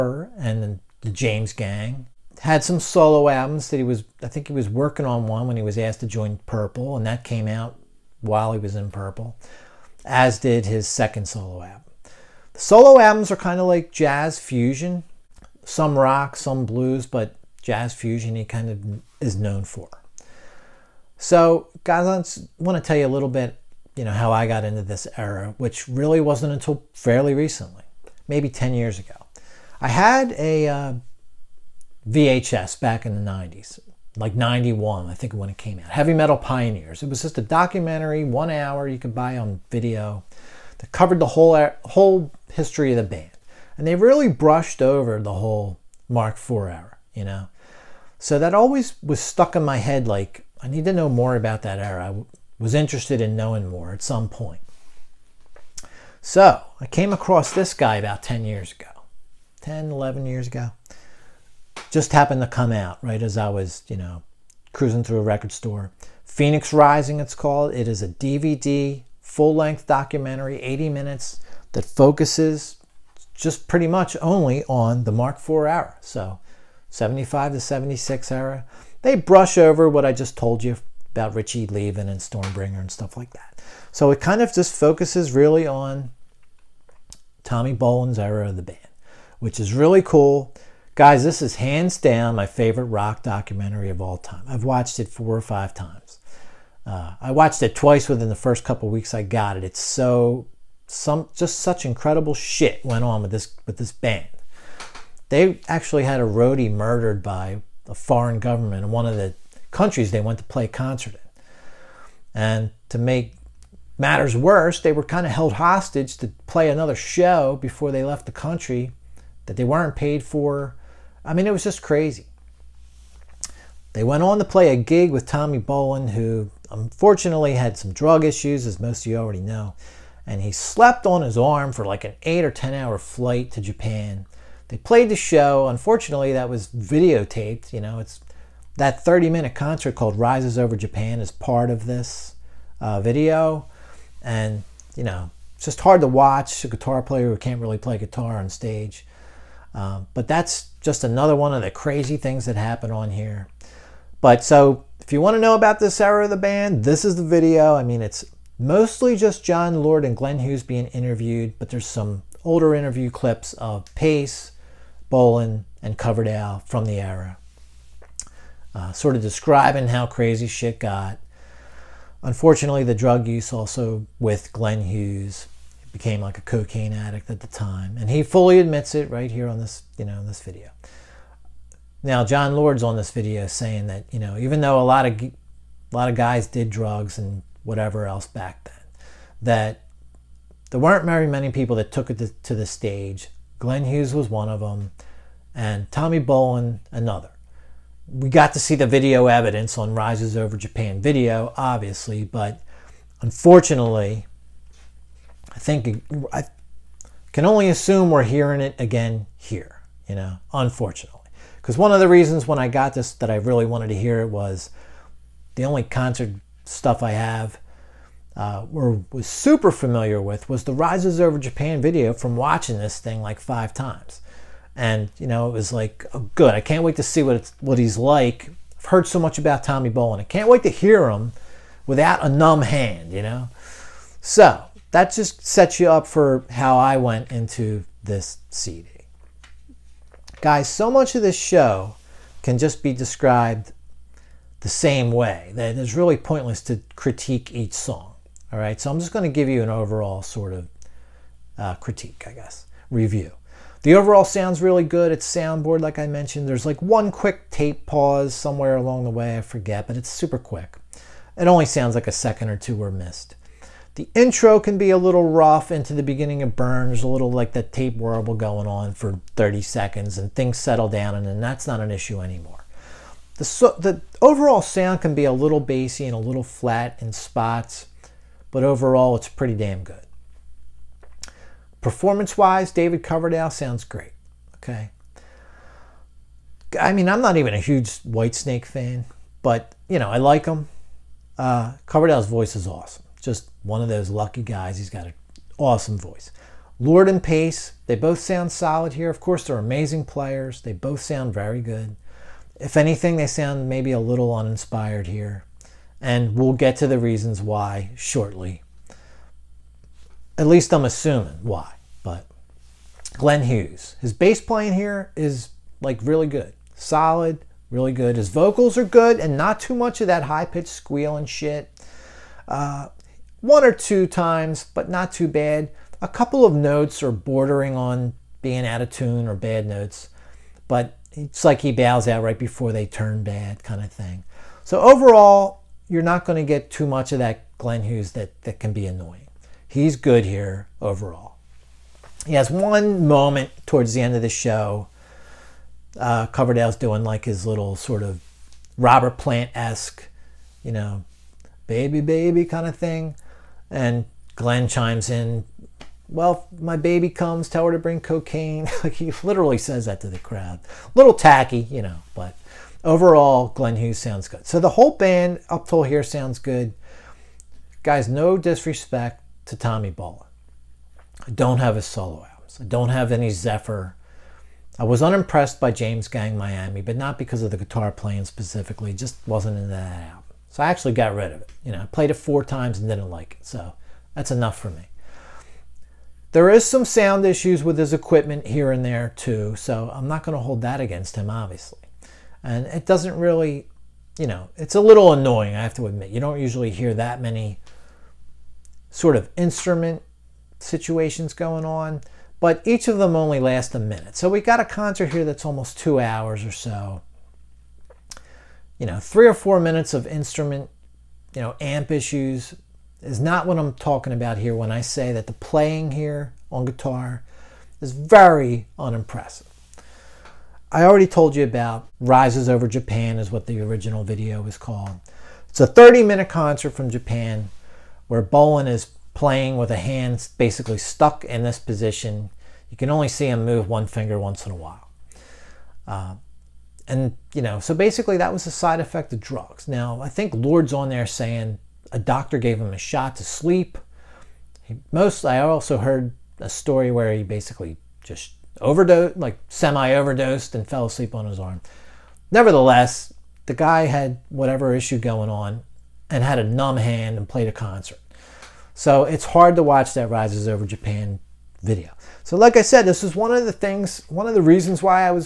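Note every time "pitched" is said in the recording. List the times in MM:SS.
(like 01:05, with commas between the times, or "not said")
05:20.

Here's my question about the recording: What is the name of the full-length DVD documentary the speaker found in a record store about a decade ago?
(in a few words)
Phoenix Rising.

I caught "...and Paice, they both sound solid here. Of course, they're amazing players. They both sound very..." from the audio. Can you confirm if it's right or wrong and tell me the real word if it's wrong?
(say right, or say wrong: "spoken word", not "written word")
right.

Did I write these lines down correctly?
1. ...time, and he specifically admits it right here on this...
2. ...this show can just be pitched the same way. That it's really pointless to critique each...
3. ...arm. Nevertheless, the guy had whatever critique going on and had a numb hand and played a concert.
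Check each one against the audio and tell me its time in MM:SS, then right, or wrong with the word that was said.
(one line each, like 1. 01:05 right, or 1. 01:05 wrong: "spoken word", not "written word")
1. 02:57 wrong: "fully", not "specifically"
2. 04:01 wrong: "described", not "pitched"
3. 07:31 wrong: "issue", not "critique".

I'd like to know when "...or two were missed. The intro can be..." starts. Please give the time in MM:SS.
04:22.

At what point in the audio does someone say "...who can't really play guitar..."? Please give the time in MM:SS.
02:27.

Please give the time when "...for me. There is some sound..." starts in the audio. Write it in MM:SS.
06:24.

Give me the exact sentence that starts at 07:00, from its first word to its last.
I already told you about Rises Over Japan is what the original video was called.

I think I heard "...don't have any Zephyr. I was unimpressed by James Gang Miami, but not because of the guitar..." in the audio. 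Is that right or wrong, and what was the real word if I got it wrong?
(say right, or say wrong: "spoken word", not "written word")
right.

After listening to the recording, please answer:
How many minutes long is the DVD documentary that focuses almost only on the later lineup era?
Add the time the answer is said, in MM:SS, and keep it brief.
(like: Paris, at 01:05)
80 minutes, at 01:10.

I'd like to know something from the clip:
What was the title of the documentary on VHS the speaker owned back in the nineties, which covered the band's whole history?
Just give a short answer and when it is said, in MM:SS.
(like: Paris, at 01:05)
Heavy Metal Pioneers, at 00:35.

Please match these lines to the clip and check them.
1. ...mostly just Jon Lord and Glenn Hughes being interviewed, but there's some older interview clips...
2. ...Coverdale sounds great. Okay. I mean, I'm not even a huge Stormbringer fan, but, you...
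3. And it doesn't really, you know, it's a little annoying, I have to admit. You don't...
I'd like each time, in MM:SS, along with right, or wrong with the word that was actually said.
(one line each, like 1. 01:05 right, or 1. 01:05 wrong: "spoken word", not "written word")
1. 02:38 right
2. 04:43 wrong: "Whitesnake", not "Stormbringer"
3. 06:32 right.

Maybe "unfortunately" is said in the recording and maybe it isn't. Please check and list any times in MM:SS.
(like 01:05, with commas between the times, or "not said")
02:06, 02:15, 02:52, 03:23, 03:30.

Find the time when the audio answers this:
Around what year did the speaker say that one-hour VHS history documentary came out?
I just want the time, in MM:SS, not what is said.
00:34.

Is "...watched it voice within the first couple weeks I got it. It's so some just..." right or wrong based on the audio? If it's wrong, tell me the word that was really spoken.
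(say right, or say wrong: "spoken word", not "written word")
wrong: "twice", not "voice".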